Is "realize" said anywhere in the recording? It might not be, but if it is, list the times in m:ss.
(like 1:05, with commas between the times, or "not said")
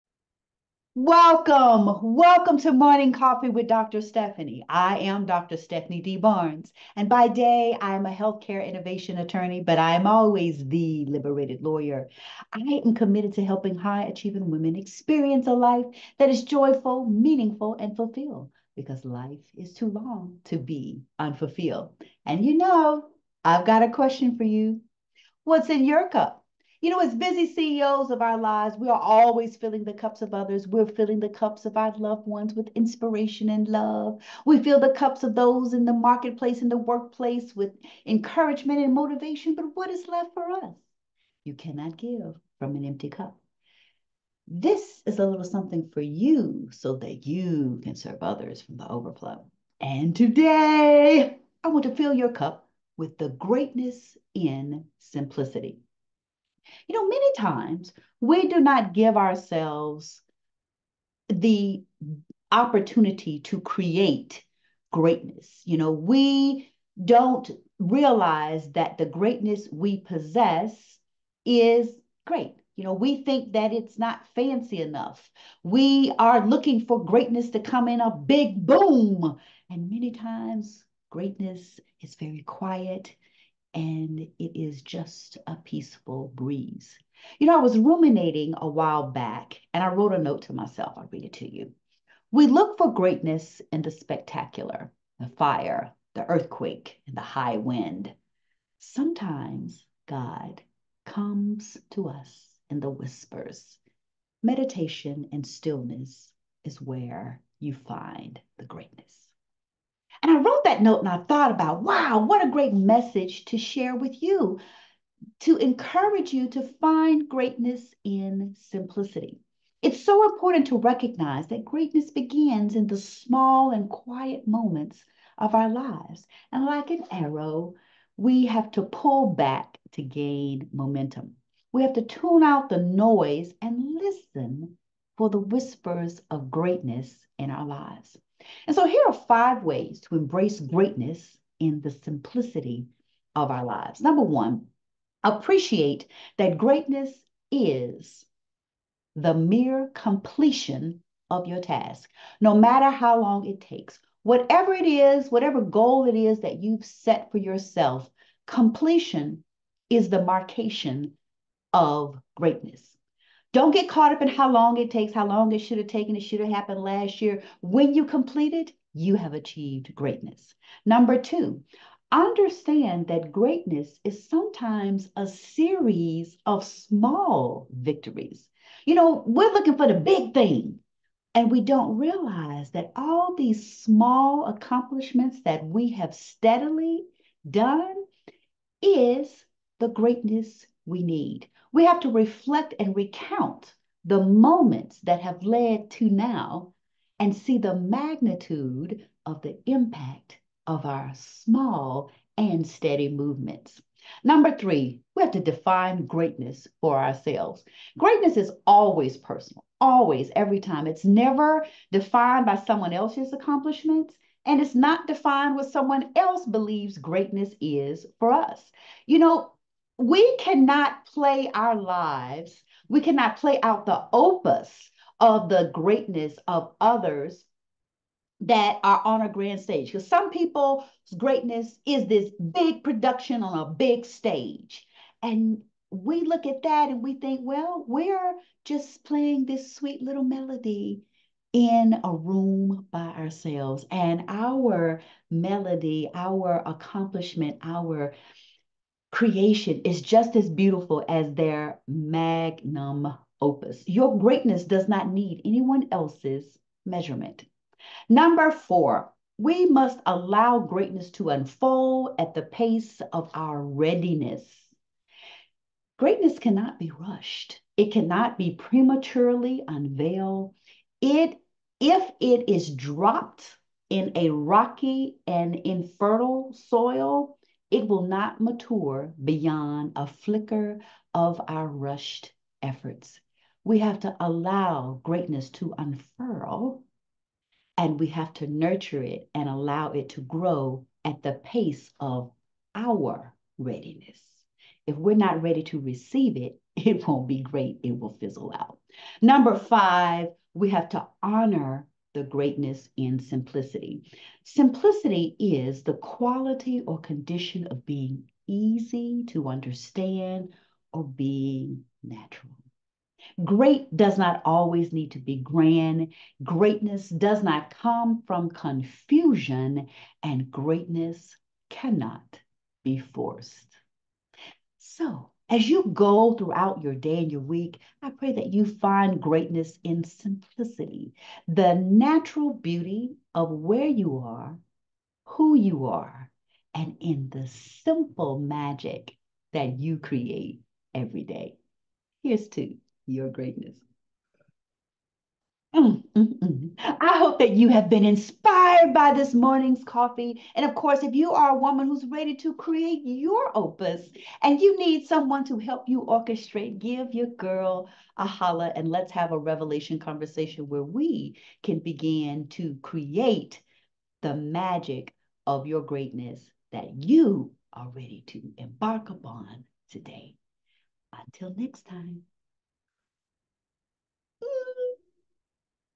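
1:07, 3:01.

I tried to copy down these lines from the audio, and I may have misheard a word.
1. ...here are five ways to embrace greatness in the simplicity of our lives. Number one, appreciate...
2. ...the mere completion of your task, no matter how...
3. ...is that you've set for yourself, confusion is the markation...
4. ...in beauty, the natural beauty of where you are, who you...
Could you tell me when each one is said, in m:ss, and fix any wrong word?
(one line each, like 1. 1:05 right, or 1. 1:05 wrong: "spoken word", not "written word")
1. 2:18 right
2. 2:29 right
3. 2:36 wrong: "completion", not "confusion"
4. 5:29 wrong: "simplicity", not "beauty".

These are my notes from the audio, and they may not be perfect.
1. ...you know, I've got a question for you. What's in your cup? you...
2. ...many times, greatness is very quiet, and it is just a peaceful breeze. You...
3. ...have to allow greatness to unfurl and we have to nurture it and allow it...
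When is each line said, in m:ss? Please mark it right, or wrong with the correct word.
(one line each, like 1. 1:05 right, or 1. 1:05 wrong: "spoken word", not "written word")
1. 0:22 right
2. 1:19 right
3. 4:43 right.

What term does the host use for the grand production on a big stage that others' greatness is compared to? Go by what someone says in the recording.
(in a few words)
Magnum opus.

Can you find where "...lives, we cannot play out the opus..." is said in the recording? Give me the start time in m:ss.
3:41.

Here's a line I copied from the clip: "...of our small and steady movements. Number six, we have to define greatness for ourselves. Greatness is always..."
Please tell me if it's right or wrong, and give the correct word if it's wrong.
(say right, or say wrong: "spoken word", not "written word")
wrong: "three", not "six".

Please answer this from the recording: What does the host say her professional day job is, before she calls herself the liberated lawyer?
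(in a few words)
Healthcare innovation attorney.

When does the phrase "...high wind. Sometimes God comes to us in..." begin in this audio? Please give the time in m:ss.
1:37.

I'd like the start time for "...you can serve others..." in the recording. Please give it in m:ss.
0:47.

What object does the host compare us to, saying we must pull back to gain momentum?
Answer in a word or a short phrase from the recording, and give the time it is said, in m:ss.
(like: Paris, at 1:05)
An arrow, at 2:06.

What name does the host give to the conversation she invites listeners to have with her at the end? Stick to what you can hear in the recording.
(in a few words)
Revelation conversation.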